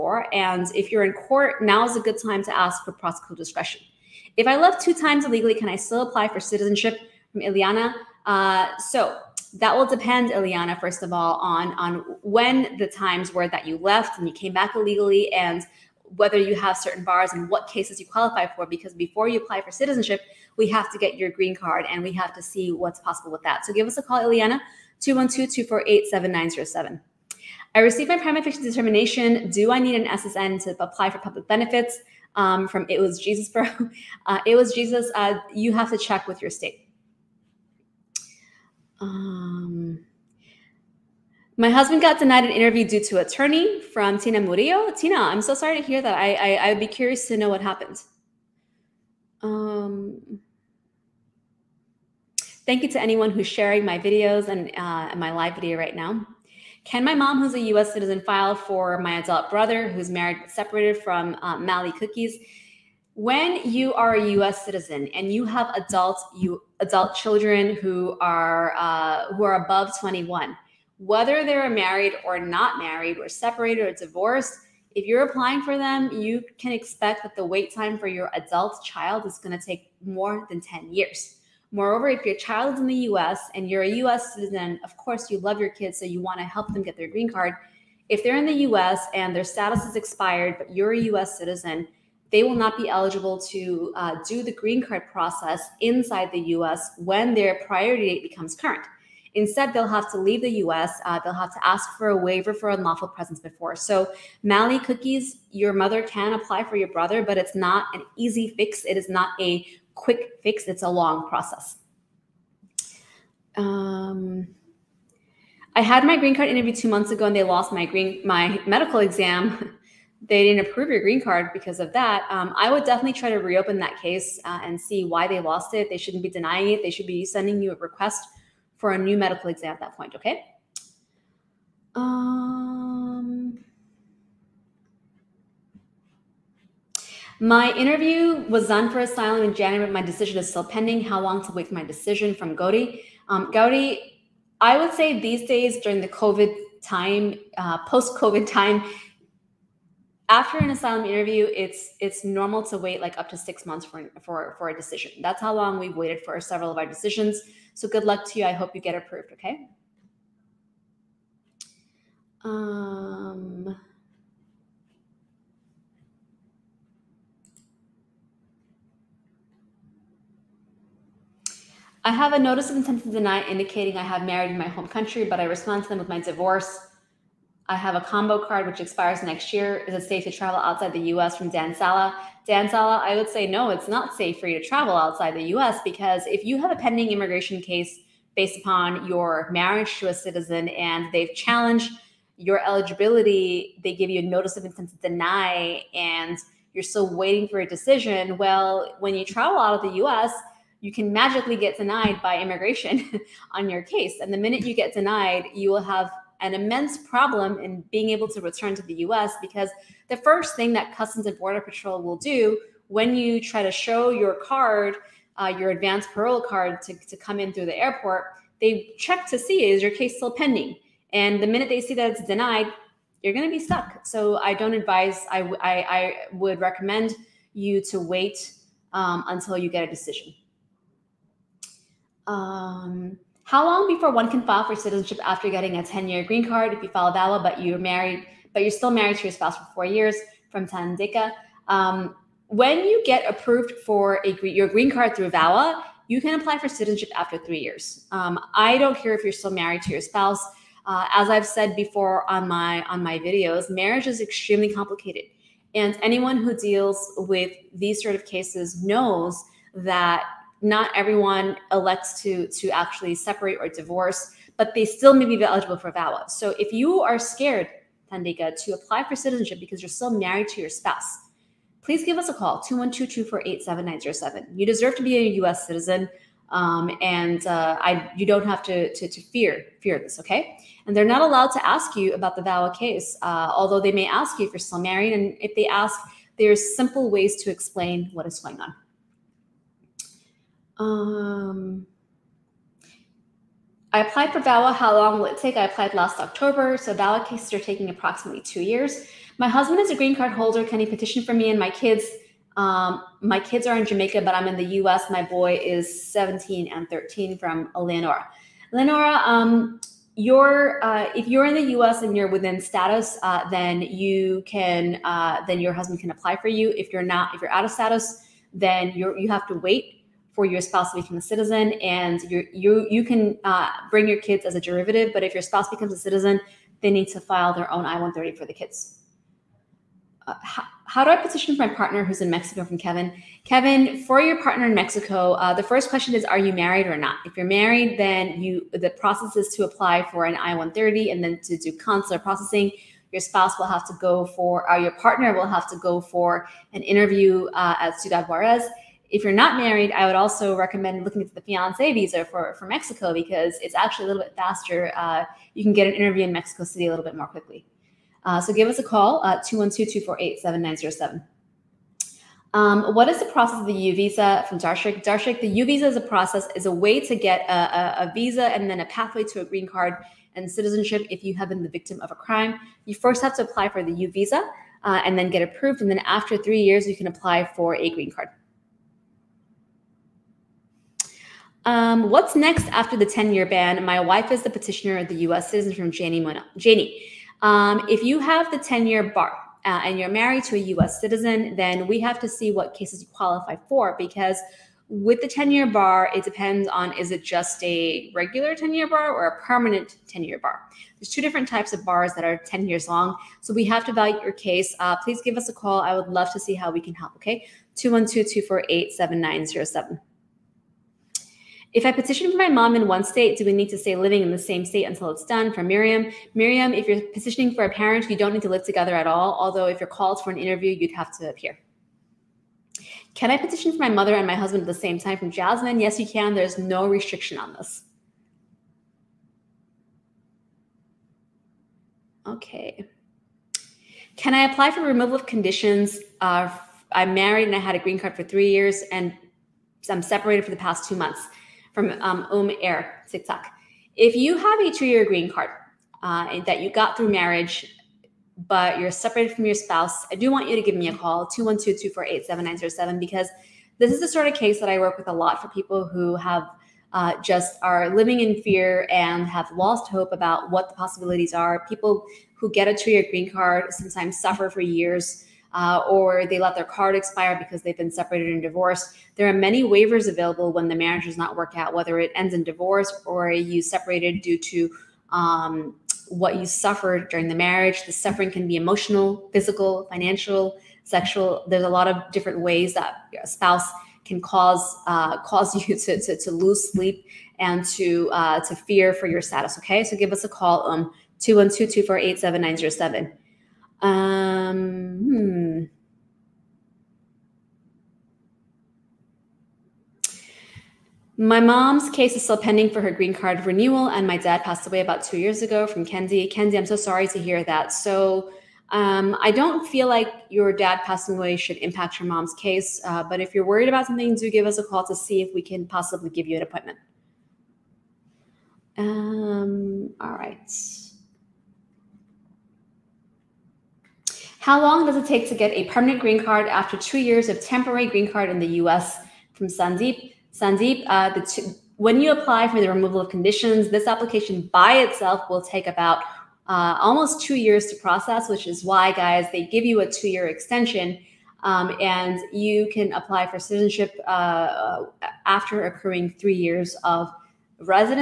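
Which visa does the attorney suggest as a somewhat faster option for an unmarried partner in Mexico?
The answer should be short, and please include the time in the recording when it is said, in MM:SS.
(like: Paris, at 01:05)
fiance visa, at 05:51.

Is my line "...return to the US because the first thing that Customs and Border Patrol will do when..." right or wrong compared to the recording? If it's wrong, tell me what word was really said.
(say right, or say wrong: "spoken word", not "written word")
right.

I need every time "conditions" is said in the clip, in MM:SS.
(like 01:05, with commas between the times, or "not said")
07:15, 08:53.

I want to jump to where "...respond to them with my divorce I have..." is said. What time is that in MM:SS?
02:55.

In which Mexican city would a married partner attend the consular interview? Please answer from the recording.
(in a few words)
Ciudad Juarez.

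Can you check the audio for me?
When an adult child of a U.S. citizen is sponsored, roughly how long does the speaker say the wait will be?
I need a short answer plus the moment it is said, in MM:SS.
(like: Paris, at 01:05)
more than 10 years, at 01:20.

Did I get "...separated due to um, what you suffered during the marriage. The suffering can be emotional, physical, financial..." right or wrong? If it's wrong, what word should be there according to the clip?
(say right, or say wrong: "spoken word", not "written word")
right.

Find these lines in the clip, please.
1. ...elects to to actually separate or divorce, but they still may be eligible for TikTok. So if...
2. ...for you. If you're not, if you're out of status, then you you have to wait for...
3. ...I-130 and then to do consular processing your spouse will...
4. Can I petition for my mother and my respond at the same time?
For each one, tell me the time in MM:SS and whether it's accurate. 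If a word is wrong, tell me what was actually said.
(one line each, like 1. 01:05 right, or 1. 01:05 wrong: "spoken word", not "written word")
1. 04:21 wrong: "VAWA", not "TikTok"
2. 05:16 right
3. 05:40 right
4. 07:03 wrong: "husband", not "respond".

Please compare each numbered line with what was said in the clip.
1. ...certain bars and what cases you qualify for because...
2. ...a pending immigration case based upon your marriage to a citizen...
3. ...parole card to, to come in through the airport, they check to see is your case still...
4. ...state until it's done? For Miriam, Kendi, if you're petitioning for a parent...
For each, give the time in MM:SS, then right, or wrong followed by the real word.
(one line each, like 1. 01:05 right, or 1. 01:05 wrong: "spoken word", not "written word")
1. 00:16 right
2. 03:06 right
3. 03:36 right
4. 06:54 wrong: "Miriam", not "Kendi".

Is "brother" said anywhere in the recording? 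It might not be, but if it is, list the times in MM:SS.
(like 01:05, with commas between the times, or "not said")
00:59, 01:46.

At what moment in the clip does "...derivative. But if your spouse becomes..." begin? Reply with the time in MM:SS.
05:24.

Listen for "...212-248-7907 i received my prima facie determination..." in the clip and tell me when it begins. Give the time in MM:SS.
00:24.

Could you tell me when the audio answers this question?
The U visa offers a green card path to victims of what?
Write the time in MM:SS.
06:12.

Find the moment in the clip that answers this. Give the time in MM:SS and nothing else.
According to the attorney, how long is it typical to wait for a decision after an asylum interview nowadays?
02:33.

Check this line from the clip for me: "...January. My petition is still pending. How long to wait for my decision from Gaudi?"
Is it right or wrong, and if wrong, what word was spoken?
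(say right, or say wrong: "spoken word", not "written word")
wrong: "decision", not "petition".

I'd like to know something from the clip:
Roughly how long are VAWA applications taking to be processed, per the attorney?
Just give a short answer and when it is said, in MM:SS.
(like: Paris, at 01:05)
2 years, at 04:57.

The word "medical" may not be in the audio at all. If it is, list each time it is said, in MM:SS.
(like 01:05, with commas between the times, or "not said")
01:58, 02:09.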